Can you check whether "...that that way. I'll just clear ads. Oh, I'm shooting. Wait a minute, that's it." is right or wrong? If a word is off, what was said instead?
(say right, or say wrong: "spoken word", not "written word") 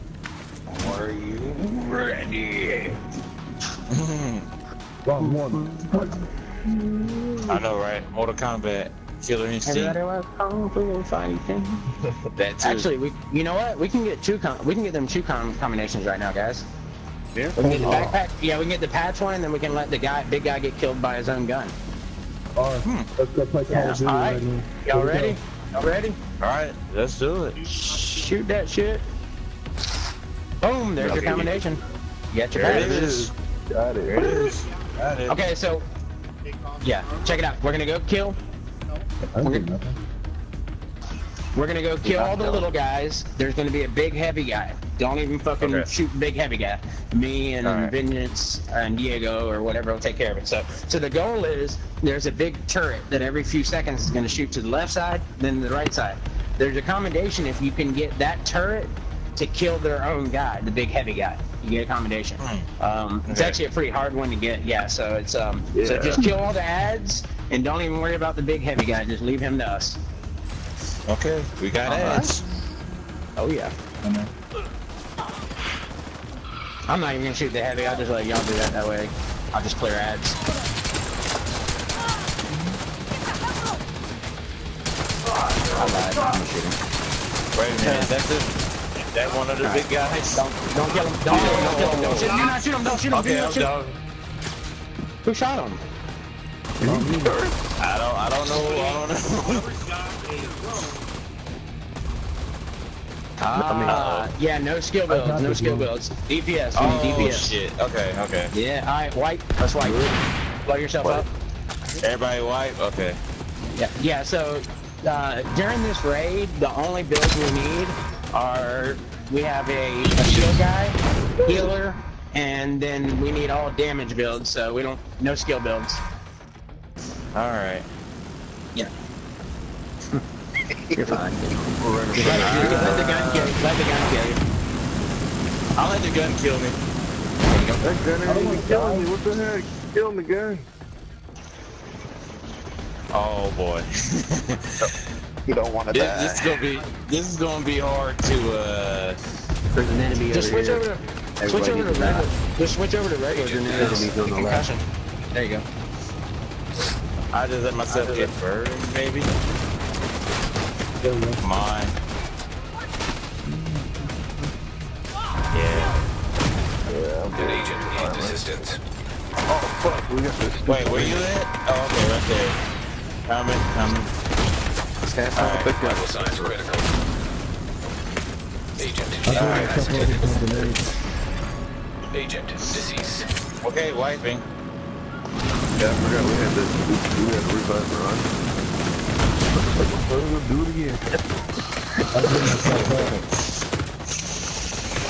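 right.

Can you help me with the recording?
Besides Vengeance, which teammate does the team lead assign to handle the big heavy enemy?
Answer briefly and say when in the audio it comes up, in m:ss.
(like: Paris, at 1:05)
Diego, at 0:48.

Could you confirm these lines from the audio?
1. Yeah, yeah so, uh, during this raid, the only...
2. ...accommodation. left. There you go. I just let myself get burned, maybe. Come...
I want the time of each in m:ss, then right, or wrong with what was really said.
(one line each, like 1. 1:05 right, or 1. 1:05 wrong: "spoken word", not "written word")
1. 1:53 right
2. 2:34 wrong: "concussion", not "accommodation".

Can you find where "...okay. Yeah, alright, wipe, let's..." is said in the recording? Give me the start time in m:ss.
1:48.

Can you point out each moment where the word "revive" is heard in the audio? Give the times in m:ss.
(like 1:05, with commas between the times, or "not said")
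3:07.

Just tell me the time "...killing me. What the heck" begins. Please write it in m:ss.
2:18.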